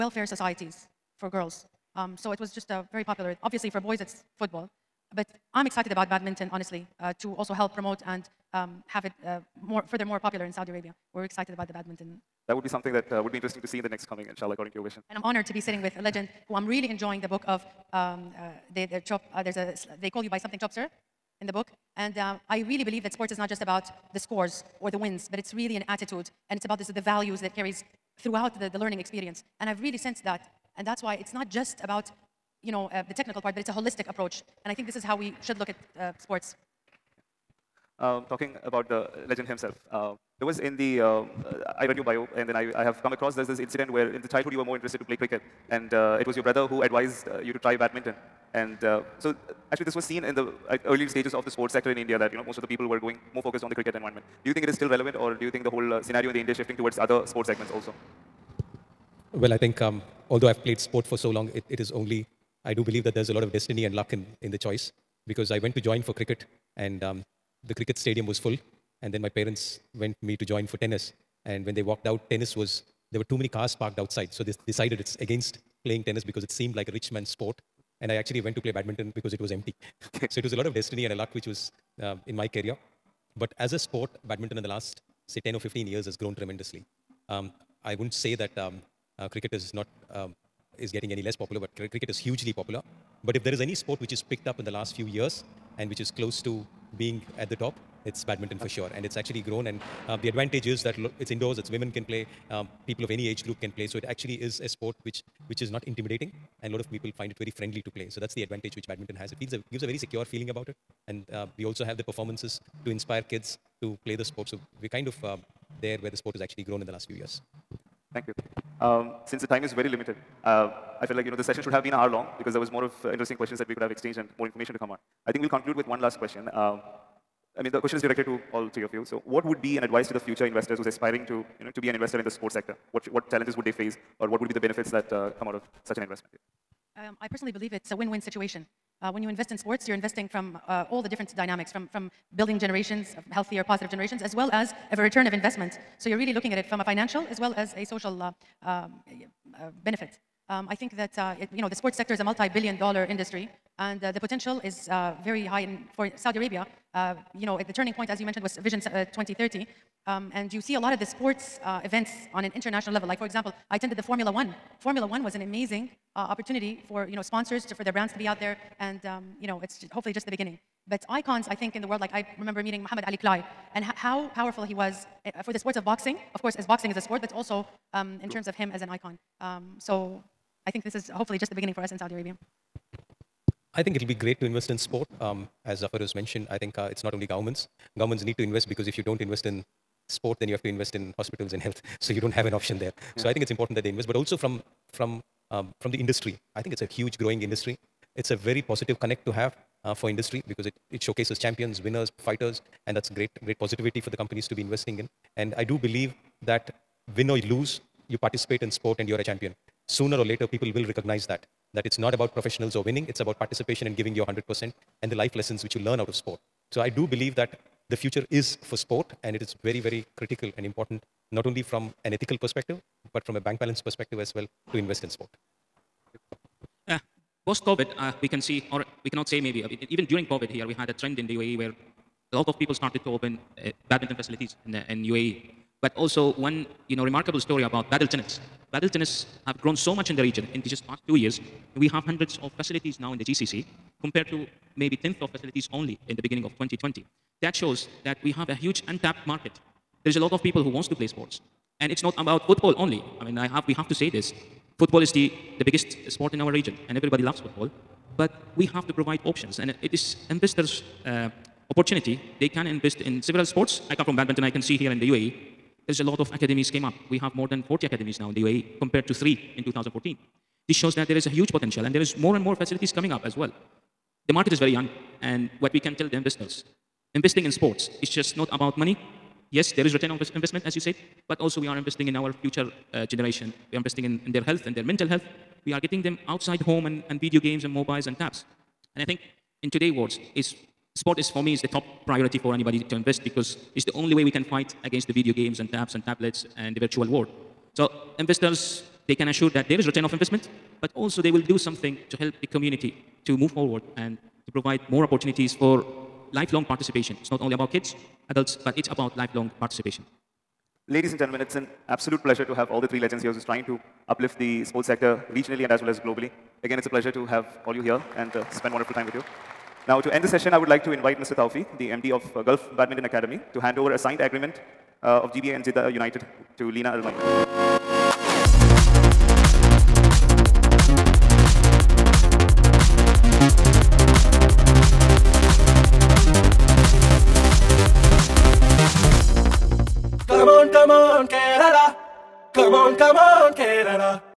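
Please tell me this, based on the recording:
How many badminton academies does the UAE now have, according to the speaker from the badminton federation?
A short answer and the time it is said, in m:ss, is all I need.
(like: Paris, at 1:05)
More than 40, at 4:27.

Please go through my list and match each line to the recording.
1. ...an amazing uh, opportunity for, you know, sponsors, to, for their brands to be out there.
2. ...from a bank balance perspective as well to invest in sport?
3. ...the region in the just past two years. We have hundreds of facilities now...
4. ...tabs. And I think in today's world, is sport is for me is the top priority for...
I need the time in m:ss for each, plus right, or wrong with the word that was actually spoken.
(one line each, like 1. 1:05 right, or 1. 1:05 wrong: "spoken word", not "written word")
1. 2:45 right
2. 3:43 right
3. 4:00 right
4. 4:48 right.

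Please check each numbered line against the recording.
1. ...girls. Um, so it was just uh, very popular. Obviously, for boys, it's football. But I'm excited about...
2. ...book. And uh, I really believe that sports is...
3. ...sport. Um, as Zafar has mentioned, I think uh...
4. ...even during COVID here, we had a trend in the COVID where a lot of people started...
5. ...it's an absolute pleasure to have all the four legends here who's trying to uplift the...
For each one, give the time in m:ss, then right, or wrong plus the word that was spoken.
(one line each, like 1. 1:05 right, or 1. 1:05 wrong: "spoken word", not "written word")
1. 0:01 right
2. 0:21 right
3. 3:04 right
4. 3:49 wrong: "UAE", not "COVID"
5. 5:11 wrong: "three", not "four".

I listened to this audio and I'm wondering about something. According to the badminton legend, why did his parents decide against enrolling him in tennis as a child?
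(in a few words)
Too many cars parked outside.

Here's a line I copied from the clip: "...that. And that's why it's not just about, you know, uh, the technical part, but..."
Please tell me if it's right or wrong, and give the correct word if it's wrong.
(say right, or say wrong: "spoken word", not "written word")
right.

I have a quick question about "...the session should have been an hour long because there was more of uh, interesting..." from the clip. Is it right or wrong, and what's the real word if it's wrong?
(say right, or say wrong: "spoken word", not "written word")
right.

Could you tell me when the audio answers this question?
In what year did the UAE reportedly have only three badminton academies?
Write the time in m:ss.
4:29.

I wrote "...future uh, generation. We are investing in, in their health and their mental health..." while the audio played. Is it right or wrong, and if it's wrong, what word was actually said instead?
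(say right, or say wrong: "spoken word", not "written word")
right.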